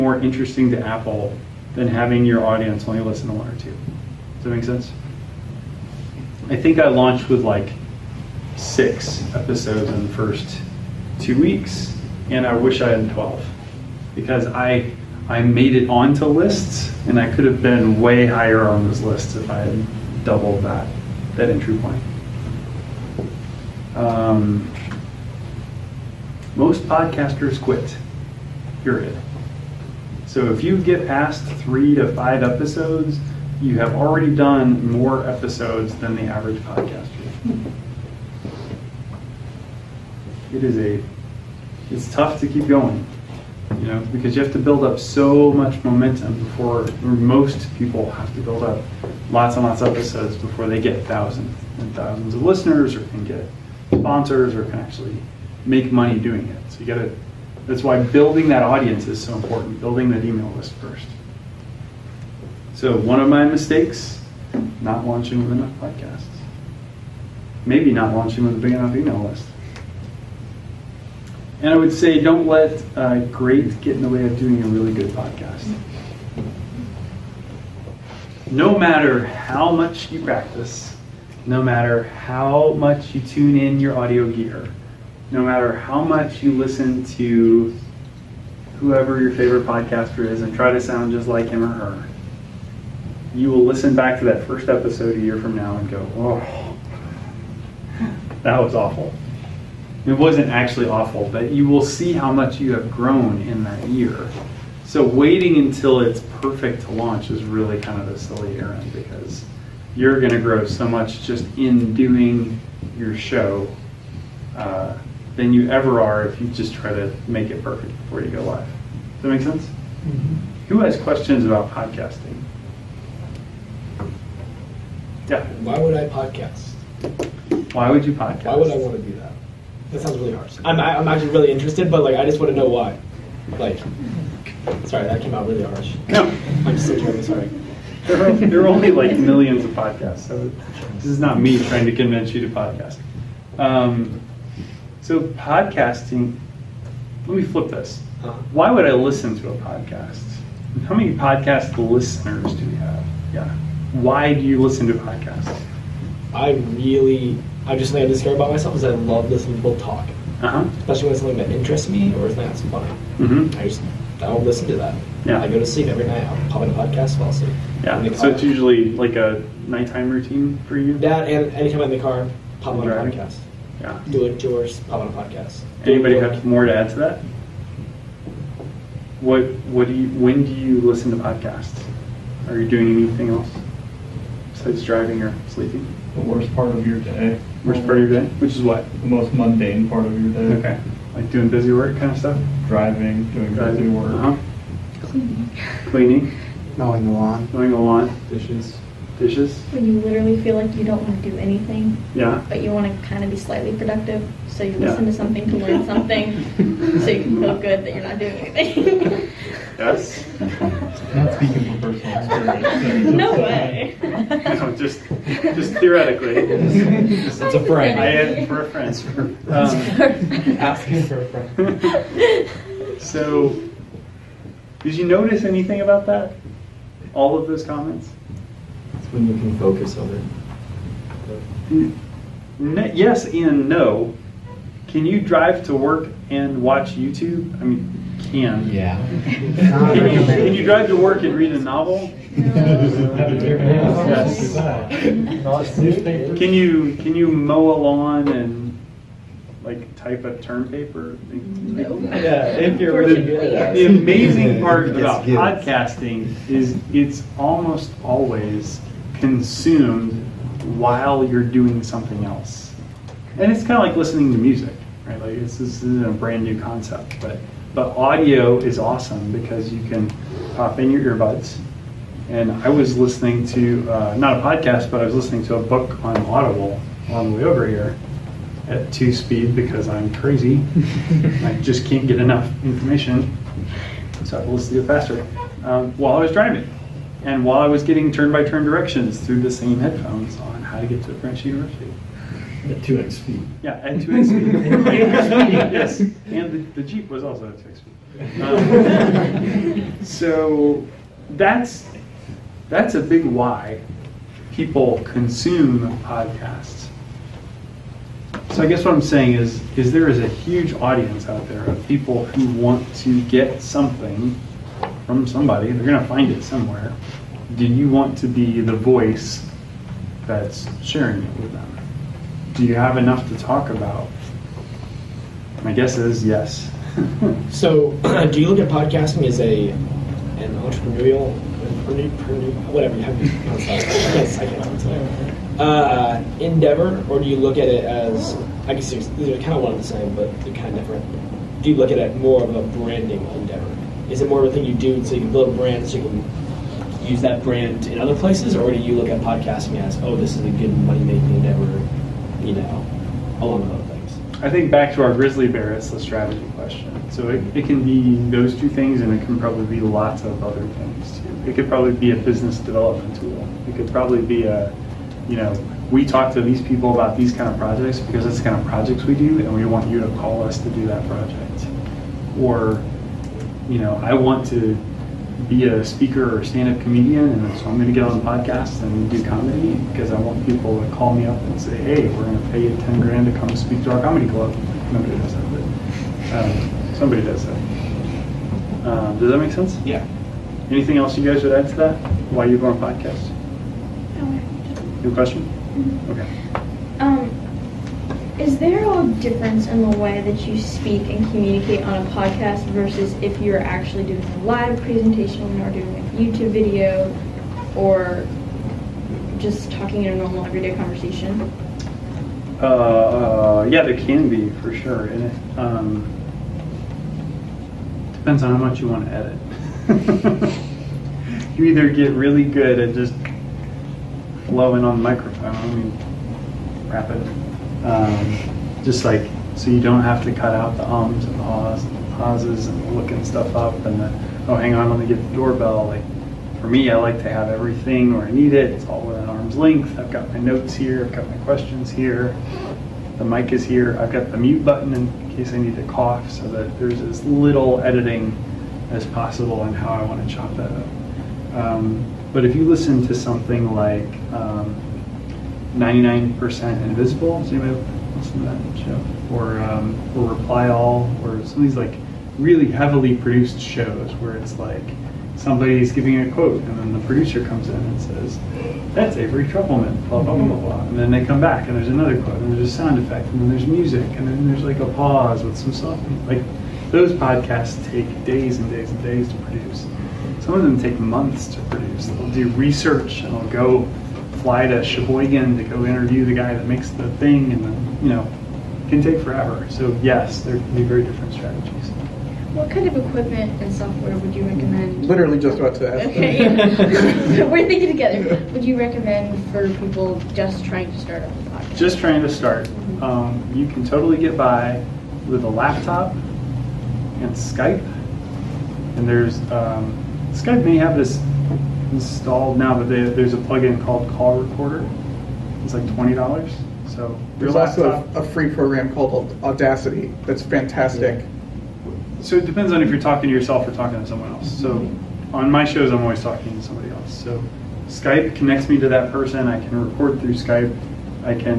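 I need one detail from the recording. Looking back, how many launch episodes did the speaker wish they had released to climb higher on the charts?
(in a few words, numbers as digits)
12.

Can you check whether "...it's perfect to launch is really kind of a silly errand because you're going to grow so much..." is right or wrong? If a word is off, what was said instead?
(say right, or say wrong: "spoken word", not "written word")
right.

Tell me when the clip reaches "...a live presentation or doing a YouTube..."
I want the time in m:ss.
6:44.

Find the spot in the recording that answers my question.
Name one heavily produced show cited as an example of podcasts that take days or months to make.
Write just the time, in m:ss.
7:35.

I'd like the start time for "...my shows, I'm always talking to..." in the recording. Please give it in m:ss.
8:45.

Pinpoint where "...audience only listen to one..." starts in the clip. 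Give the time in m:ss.
0:02.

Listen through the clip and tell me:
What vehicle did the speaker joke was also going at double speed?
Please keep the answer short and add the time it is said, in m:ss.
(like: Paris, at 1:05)
Jeep, at 4:56.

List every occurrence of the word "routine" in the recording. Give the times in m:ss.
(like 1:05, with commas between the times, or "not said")
2:50.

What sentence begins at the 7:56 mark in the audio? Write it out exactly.
Like those podcasts take days and days and days to produce.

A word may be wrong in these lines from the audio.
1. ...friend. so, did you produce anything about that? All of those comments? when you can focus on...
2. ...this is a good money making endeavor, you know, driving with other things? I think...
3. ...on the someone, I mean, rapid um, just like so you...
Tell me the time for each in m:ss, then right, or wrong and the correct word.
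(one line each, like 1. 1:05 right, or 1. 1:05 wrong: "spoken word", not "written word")
1. 3:41 wrong: "notice", not "produce"
2. 5:50 wrong: "along", not "driving"
3. 7:04 wrong: "microphone", not "someone".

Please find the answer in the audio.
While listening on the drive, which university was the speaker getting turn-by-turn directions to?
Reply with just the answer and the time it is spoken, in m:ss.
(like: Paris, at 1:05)
French University, at 4:51.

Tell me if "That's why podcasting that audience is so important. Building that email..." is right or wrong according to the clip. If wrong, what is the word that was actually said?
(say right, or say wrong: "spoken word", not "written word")
wrong: "building", not "podcasting".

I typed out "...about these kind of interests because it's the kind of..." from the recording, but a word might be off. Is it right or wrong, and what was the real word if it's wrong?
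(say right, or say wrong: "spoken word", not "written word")
wrong: "projects", not "interests".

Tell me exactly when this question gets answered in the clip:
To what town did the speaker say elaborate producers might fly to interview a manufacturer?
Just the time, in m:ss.
8:04.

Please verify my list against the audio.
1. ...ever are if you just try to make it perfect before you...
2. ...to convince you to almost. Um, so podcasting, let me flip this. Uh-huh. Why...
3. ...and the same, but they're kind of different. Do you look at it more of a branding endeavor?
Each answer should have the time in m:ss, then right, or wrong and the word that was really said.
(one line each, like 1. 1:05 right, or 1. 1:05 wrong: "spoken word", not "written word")
1. 1:55 right
2. 2:21 wrong: "podcast", not "almost"
3. 5:39 right.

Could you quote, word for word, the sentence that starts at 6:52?
Uh, uh, yeah, there can be for sure.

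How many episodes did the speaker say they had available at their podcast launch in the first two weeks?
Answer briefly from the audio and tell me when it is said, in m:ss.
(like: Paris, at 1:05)
6, at 0:08.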